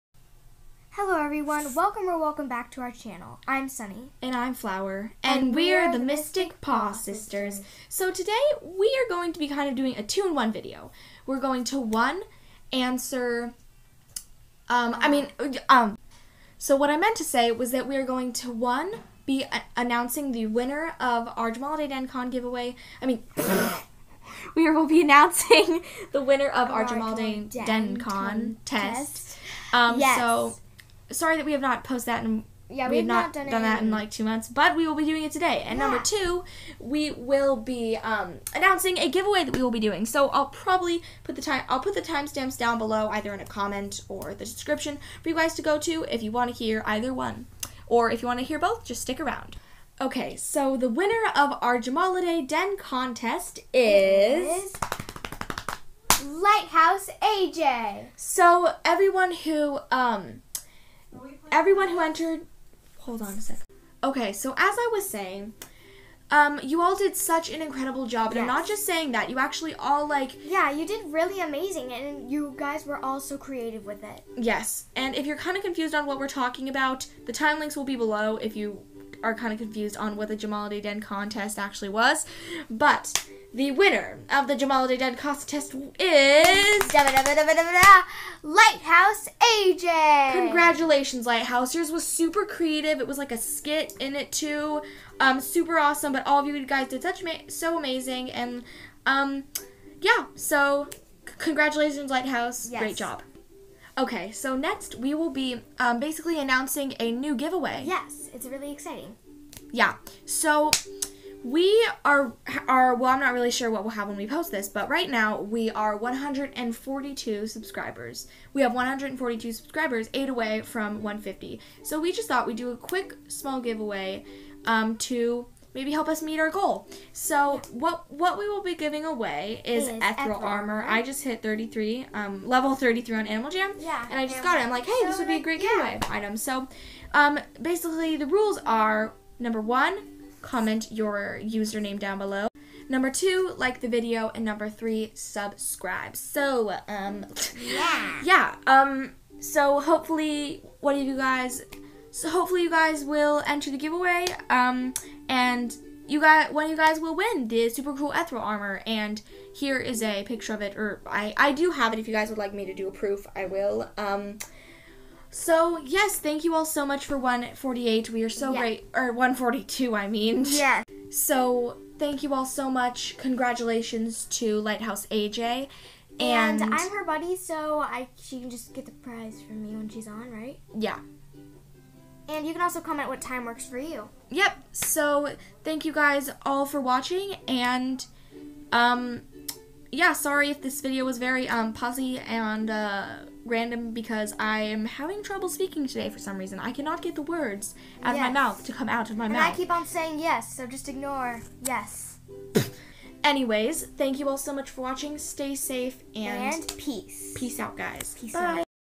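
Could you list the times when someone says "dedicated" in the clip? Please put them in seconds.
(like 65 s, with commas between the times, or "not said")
not said.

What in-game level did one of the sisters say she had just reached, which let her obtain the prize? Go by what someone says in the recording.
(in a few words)
33.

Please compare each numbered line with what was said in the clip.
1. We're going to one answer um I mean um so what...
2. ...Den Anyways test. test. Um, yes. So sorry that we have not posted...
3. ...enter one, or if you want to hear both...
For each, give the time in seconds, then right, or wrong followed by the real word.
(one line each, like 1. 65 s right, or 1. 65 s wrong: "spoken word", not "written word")
1. 11 s right
2. 27 s wrong: "Con", not "Anyways"
3. 46 s wrong: "either", not "enter".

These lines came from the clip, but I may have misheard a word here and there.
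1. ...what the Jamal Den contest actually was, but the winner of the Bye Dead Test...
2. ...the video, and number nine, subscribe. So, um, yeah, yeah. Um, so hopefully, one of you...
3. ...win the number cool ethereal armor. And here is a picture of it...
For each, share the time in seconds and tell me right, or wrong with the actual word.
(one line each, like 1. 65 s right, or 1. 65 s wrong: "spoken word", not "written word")
1. 80 s wrong: "Jamal", not "Bye"
2. 143 s wrong: "three", not "nine"
3. 157 s wrong: "super", not "number".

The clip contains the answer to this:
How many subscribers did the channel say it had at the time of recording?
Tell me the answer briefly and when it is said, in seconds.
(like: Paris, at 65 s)
142, at 118 s.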